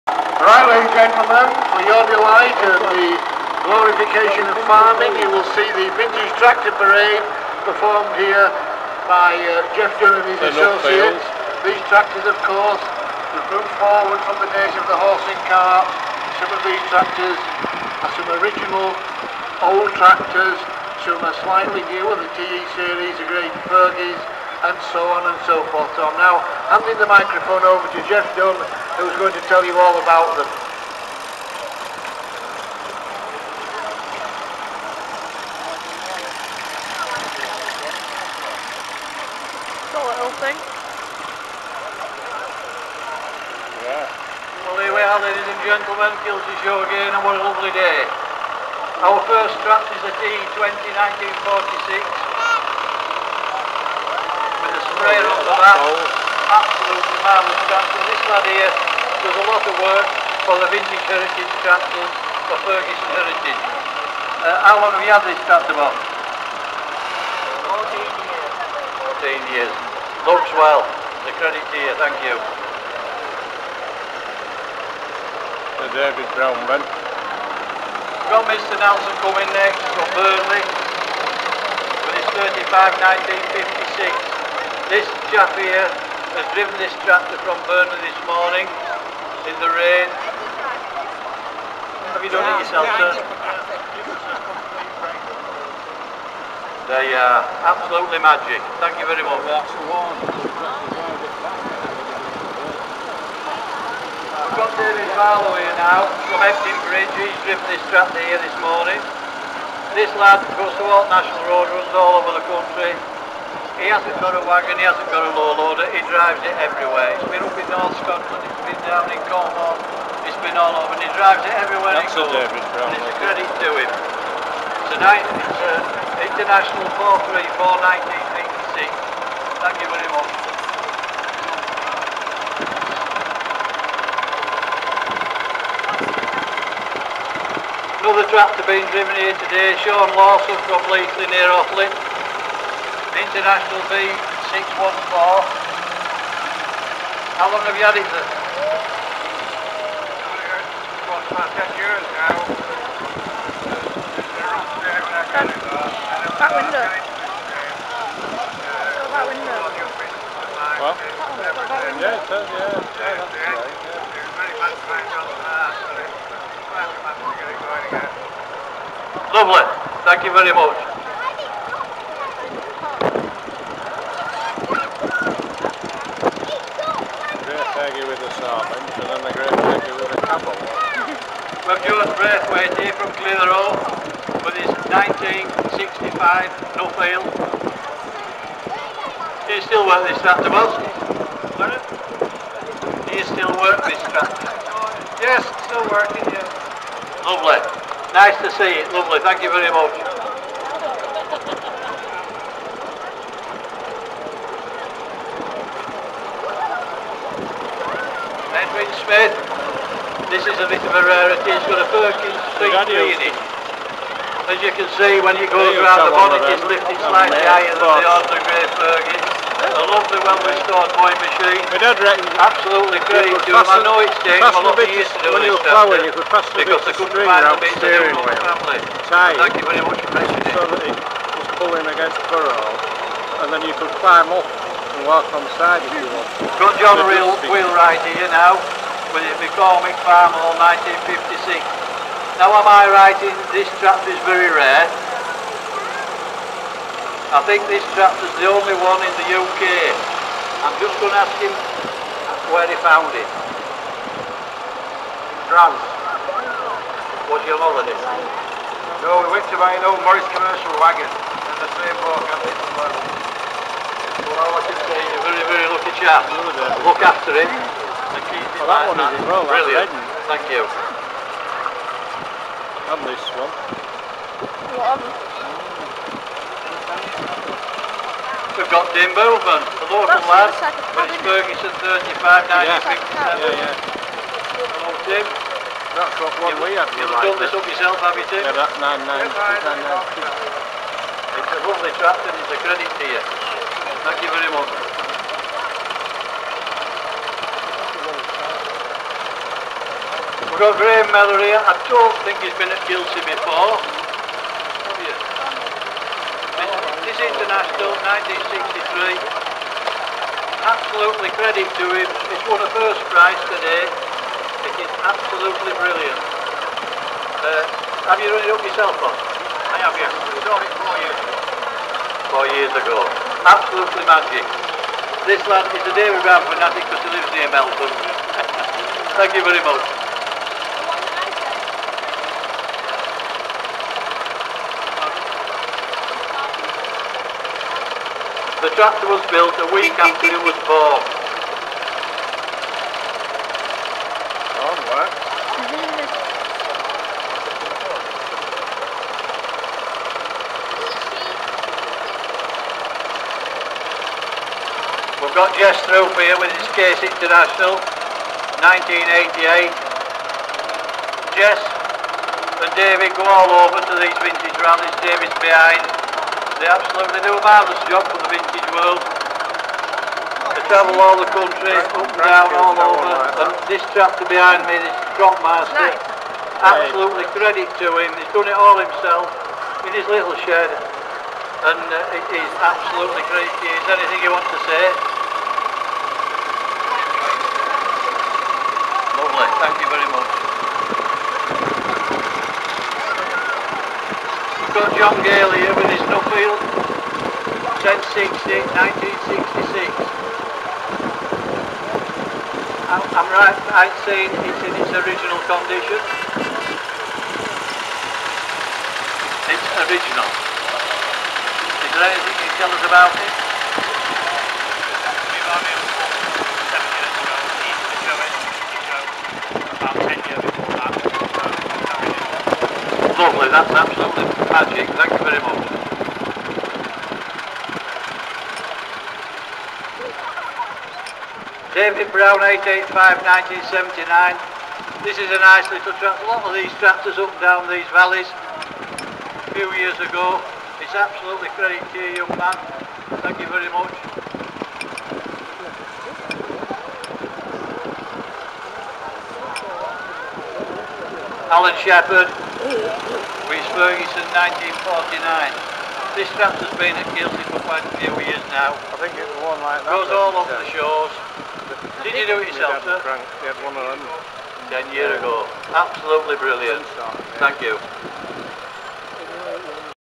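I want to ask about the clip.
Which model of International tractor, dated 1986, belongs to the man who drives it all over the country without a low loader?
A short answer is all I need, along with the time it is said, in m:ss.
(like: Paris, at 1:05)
International 434, at 2:06.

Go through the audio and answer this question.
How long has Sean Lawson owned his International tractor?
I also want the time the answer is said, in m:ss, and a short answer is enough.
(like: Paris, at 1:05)
10 years, at 2:31.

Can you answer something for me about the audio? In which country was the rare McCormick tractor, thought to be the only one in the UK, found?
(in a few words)
France.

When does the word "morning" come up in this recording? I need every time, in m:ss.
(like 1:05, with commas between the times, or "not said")
1:28, 1:48.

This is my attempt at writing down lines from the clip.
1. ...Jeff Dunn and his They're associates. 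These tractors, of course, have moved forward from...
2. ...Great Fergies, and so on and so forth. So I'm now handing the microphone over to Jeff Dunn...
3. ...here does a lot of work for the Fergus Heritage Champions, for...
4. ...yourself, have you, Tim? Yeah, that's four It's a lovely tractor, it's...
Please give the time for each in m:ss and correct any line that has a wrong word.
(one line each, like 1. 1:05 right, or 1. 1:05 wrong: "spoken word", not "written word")
1. 0:09 right
2. 0:23 right
3. 0:58 wrong: "Vintage", not "Fergus"
4. 4:47 wrong: "nine", not "four".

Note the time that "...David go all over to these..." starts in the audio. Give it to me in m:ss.
6:02.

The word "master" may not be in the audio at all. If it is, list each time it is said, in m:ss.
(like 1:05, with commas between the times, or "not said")
6:15.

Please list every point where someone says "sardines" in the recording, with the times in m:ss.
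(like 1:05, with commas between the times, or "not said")
2:58.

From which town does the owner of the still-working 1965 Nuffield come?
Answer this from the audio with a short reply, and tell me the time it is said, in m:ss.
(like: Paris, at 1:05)
Clitheroe, at 3:03.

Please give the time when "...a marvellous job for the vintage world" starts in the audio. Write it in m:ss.
6:07.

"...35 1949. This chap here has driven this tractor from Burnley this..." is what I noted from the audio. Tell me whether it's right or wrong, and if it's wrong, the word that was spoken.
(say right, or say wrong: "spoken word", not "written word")
wrong: "1956", not "1949".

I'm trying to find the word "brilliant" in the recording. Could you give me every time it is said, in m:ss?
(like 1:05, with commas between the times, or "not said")
4:29, 5:15, 7:46.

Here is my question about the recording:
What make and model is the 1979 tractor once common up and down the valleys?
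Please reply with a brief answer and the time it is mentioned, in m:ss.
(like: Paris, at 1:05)
David Brown 885, at 7:11.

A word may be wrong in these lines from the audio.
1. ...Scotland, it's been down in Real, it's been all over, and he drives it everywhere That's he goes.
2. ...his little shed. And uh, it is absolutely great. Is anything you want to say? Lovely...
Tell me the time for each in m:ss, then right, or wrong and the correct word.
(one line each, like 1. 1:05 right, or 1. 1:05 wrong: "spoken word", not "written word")
1. 1:57 wrong: "Cornwall", not "Real"
2. 6:19 right.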